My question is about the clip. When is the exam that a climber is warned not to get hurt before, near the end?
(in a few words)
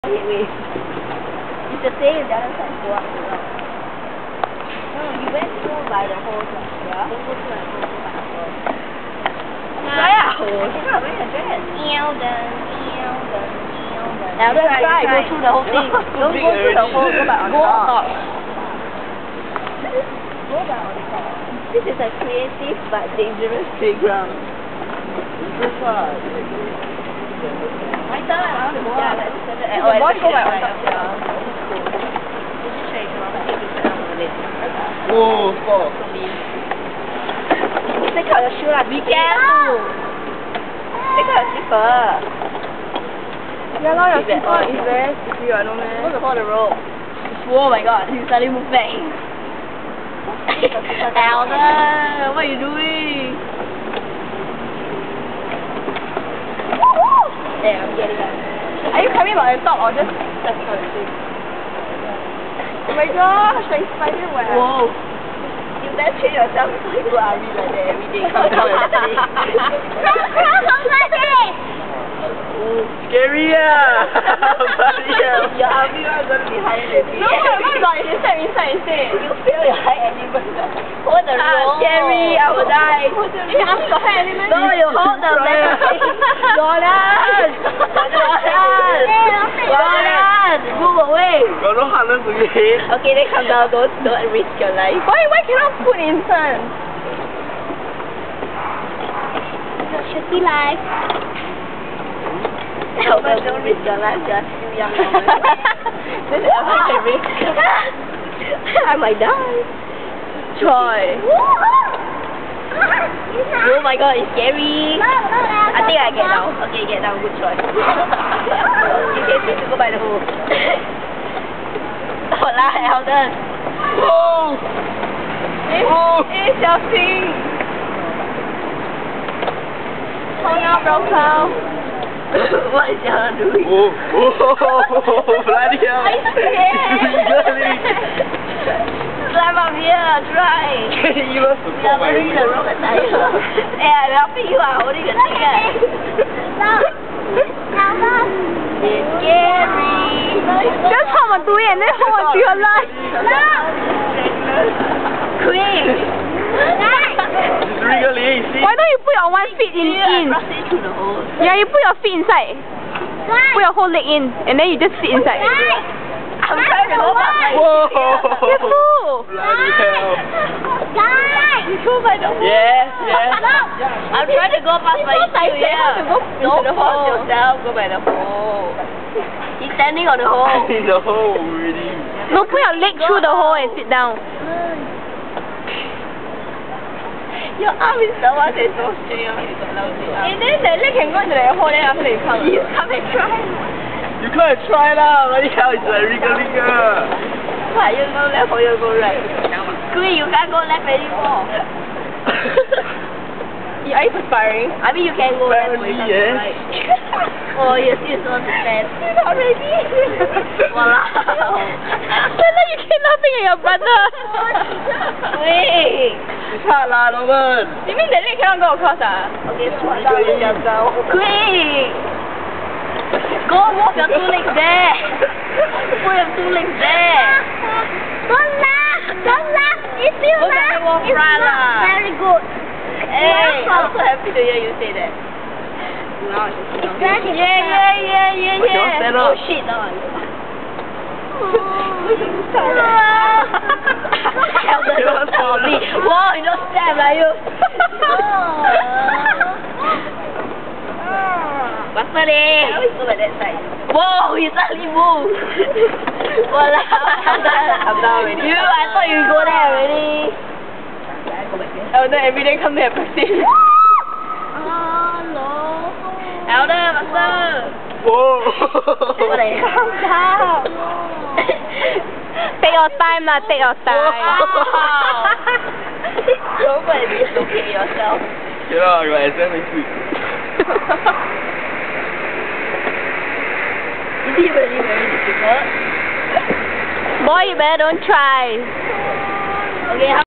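next week.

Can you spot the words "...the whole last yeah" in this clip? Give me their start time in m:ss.
0:06.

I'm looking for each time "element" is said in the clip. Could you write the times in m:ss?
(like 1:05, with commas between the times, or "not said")
1:20, 1:24.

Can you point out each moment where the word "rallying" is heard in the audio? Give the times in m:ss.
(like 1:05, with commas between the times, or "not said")
not said.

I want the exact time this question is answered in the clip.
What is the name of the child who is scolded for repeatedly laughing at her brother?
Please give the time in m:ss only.
3:32.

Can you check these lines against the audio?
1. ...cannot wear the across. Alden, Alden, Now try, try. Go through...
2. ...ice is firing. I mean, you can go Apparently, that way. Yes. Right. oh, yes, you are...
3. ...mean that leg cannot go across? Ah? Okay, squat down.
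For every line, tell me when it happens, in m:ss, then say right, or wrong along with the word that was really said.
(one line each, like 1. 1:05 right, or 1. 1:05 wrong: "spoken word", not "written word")
1. 0:10 wrong: "dress", not "across"
2. 3:23 right
3. 3:37 right.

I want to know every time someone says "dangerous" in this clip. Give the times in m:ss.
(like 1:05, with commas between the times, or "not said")
0:23.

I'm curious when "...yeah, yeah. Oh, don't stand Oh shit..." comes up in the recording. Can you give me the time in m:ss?
3:57.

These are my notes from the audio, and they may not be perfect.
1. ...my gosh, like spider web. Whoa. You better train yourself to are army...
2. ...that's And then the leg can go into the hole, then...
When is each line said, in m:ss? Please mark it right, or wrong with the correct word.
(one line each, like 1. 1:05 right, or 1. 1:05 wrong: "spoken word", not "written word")
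1. 1:02 right
2. 3:08 right.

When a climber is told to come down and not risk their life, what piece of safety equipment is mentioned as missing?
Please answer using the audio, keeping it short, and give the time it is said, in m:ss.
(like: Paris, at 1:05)
harness, at 1:31.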